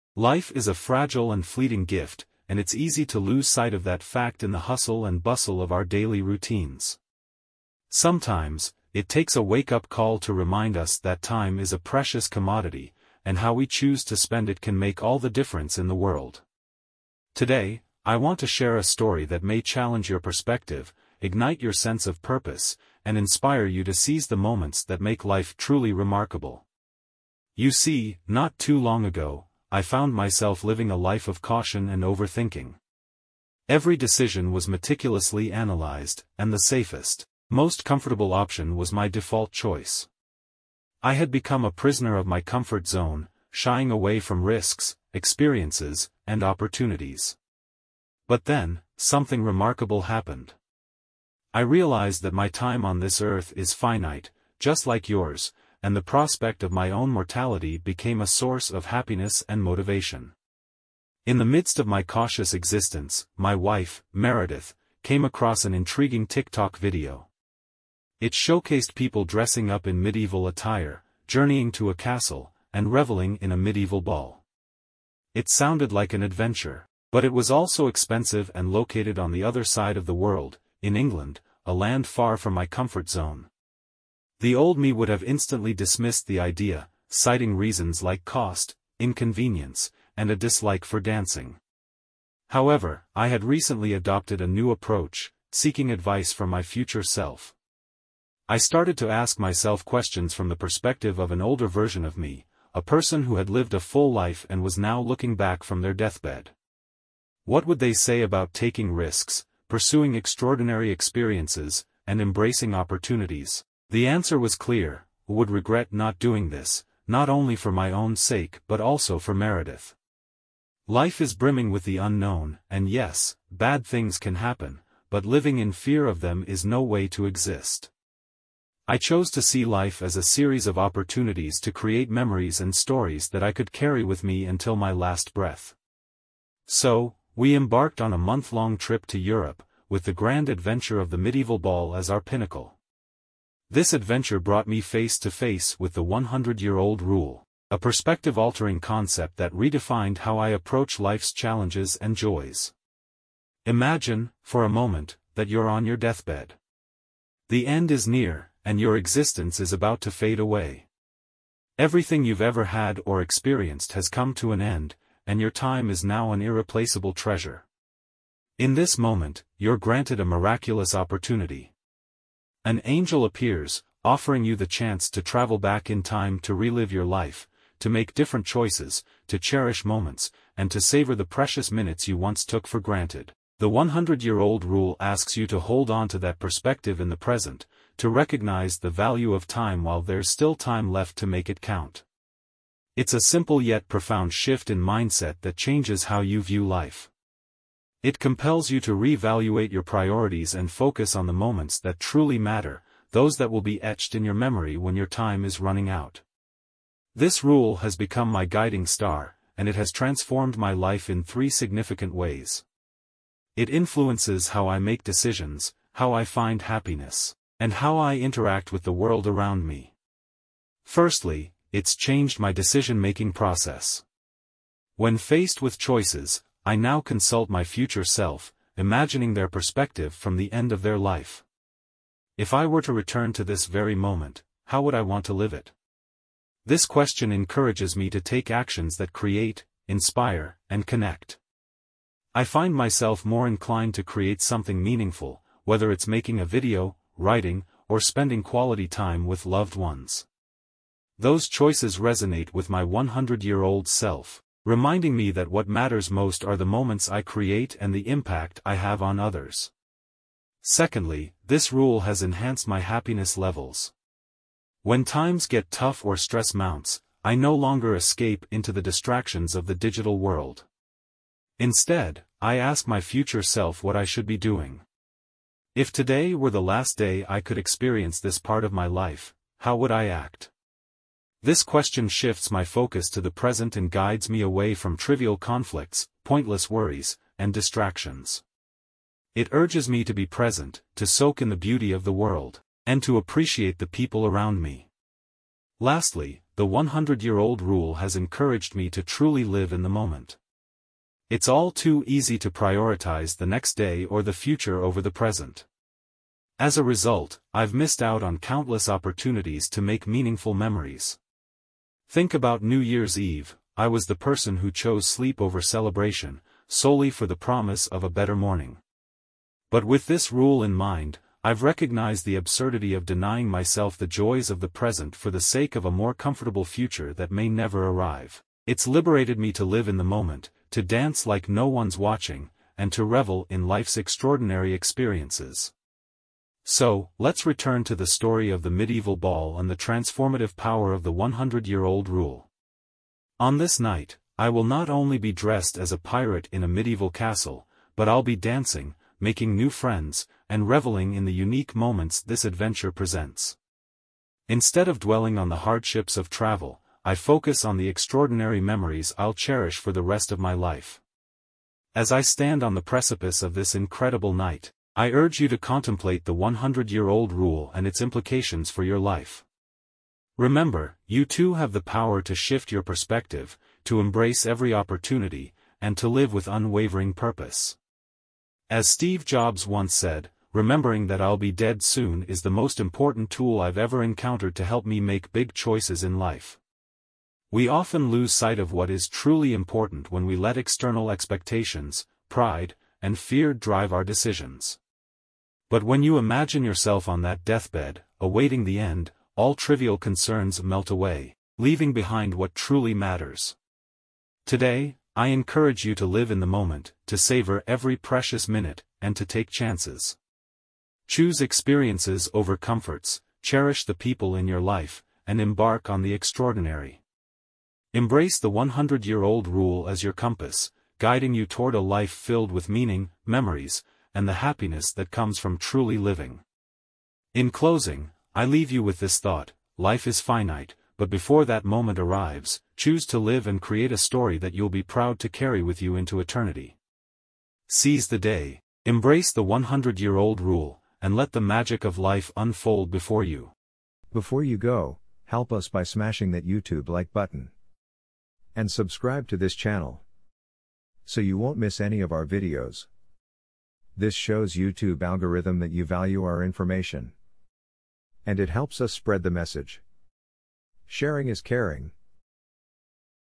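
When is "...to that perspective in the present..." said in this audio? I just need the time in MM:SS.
03:06.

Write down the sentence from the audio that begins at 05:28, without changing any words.
It's liberated me to live in the moment, to dance like no one's watching, and to revel in life's extraordinary experiences.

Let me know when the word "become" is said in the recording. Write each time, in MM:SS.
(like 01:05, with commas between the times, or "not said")
00:41, 03:27.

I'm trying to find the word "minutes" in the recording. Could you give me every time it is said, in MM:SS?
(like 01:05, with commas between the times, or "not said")
03:01, 06:48.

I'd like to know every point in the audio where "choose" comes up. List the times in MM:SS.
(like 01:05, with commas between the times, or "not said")
00:13, 06:51, 07:12.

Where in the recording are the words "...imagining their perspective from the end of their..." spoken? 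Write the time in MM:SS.
03:48.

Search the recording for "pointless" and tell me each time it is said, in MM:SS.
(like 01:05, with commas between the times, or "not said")
04:46.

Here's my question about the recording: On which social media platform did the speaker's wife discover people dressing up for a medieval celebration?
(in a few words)
TikTok.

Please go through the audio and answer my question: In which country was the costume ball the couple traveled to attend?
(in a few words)
England.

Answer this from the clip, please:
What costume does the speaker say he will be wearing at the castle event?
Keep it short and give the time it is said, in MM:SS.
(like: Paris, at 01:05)
a pirate, at 05:45.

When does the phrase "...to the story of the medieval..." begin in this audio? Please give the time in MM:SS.
05:37.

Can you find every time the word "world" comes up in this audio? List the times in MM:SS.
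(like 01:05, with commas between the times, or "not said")
00:15, 01:20, 03:38, 04:30, 04:52.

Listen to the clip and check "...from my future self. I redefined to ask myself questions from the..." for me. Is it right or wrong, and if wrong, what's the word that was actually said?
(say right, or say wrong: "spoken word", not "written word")
wrong: "started", not "redefined".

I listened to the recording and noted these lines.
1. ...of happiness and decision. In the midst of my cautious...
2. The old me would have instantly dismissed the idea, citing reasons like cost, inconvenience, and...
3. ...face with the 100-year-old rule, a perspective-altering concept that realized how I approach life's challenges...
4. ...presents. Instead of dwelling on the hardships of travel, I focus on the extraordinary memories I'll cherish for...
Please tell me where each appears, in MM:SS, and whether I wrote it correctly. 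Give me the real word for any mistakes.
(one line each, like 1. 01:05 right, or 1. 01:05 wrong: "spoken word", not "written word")
1. 00:58 wrong: "motivation", not "decision"
2. 01:24 right
3. 02:25 wrong: "redefined", not "realized"
4. 05:52 right.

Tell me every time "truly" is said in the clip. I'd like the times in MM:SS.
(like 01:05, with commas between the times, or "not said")
00:25, 03:21, 04:59, 06:29, 06:42, 07:05.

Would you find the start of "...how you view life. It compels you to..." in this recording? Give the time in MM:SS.
03:16.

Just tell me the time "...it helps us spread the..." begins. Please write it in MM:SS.
07:38.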